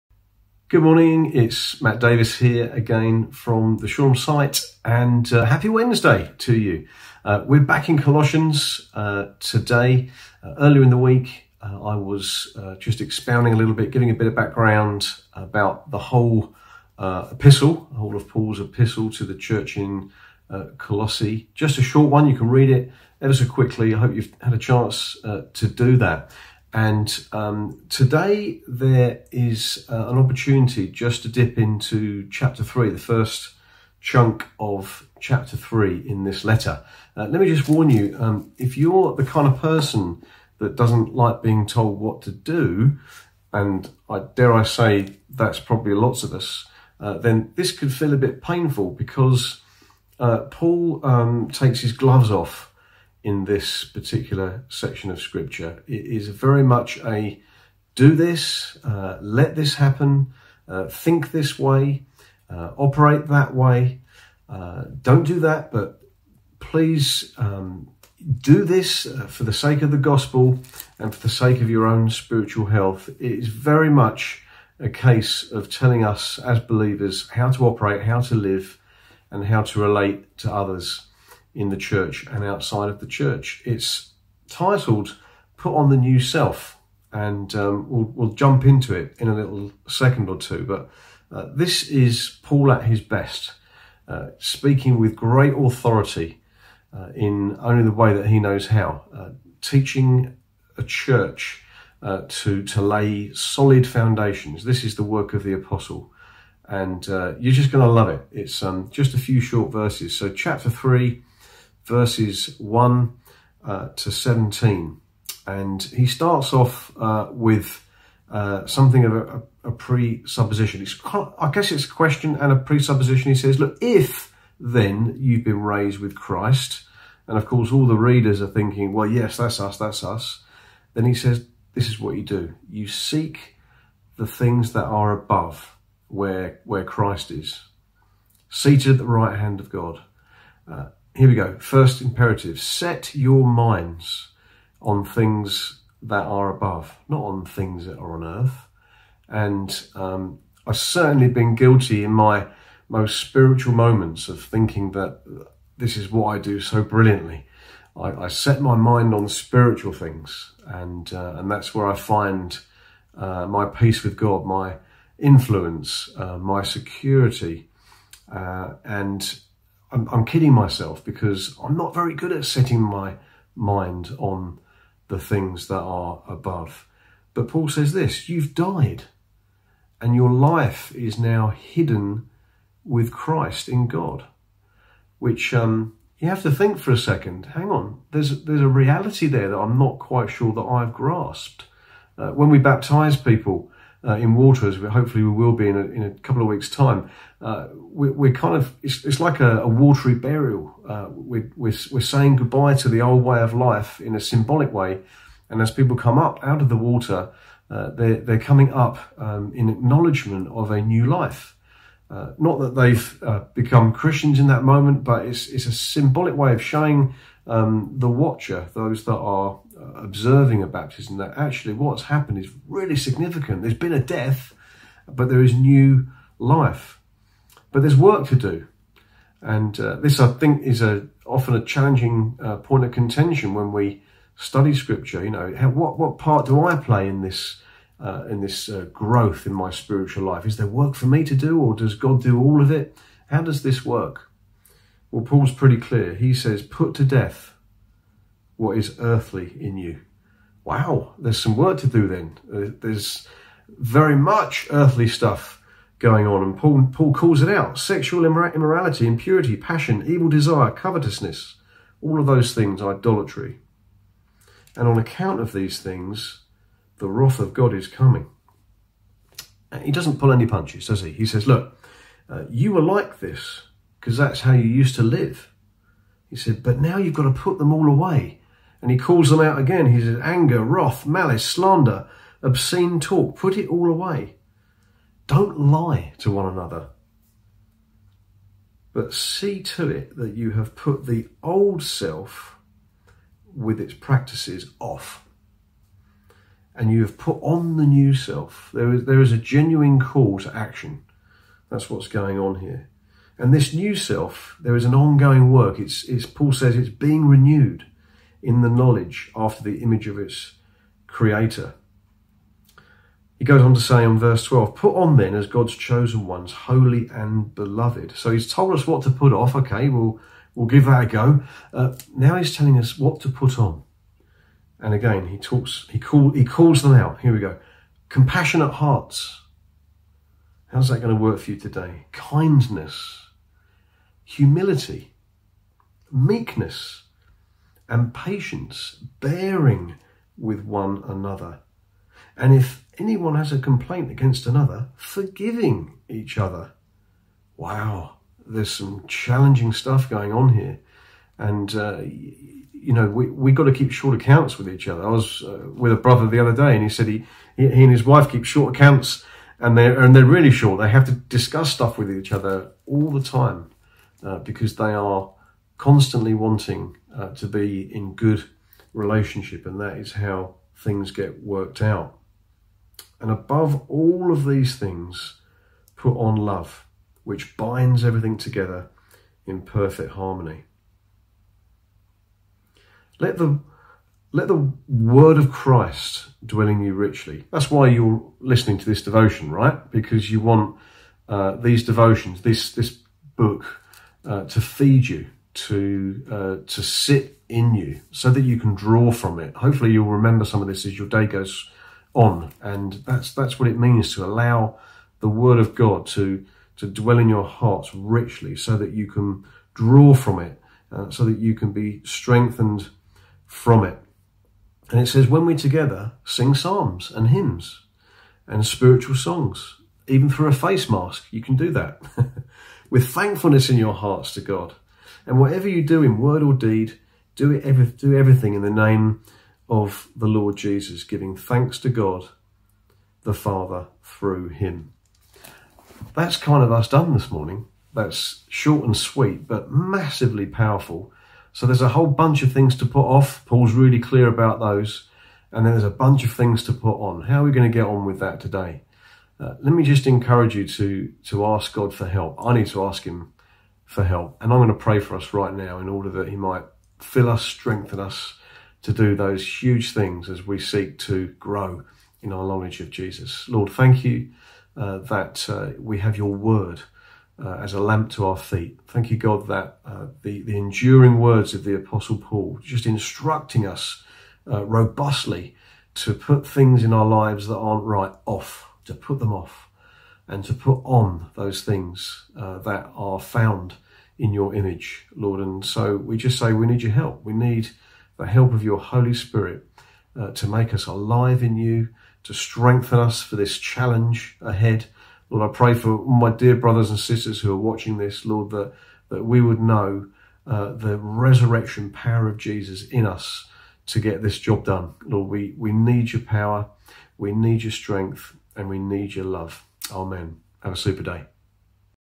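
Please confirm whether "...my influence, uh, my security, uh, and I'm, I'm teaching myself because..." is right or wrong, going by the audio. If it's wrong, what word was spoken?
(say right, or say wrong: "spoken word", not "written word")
wrong: "kidding", not "teaching".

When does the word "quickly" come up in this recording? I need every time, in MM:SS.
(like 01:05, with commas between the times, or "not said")
00:23.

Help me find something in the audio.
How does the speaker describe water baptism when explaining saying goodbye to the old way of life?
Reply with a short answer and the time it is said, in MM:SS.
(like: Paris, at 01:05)
A watery burial, at 03:19.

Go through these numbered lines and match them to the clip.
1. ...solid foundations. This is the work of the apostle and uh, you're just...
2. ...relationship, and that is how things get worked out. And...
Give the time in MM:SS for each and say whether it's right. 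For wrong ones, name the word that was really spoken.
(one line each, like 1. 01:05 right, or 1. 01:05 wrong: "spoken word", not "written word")
1. 01:43 right
2. 06:08 right.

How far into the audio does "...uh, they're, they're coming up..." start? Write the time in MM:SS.
03:27.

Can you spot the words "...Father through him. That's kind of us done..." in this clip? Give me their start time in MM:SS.
07:13.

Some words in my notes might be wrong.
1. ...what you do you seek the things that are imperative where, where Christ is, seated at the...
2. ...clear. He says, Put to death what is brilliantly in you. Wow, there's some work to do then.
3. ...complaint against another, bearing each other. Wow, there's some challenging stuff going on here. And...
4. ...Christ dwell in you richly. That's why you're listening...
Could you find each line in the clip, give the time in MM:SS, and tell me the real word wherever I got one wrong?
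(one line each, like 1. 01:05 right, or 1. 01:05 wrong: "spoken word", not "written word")
1. 02:11 wrong: "above", not "imperative"
2. 04:05 wrong: "earthly", not "brilliantly"
3. 05:43 wrong: "forgiving", not "bearing"
4. 06:25 right.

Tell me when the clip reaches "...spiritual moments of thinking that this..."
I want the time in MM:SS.
02:33.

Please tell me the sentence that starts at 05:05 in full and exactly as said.
It's, it's Paul says it's being renewed in the knowledge after the image of its creator.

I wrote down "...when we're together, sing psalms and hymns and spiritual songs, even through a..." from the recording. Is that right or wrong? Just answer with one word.
right.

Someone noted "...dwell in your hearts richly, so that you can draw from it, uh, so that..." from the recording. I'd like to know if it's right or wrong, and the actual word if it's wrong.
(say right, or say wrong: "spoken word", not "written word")
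right.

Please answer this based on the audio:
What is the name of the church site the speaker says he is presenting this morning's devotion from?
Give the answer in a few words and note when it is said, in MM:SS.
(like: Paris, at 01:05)
Shoreham, at 00:03.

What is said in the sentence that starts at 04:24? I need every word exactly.
And on account of these things, the wrath of God is coming.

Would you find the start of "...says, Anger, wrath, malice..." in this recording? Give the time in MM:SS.
04:40.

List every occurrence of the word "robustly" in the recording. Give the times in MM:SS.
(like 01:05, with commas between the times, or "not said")
07:54.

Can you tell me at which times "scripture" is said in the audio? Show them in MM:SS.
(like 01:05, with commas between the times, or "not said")
00:55, 03:54.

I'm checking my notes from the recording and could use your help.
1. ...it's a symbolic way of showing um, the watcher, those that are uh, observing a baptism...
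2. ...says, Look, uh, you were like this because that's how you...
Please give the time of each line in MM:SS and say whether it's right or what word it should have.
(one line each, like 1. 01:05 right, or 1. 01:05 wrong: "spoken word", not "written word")
1. 03:35 right
2. 04:31 right.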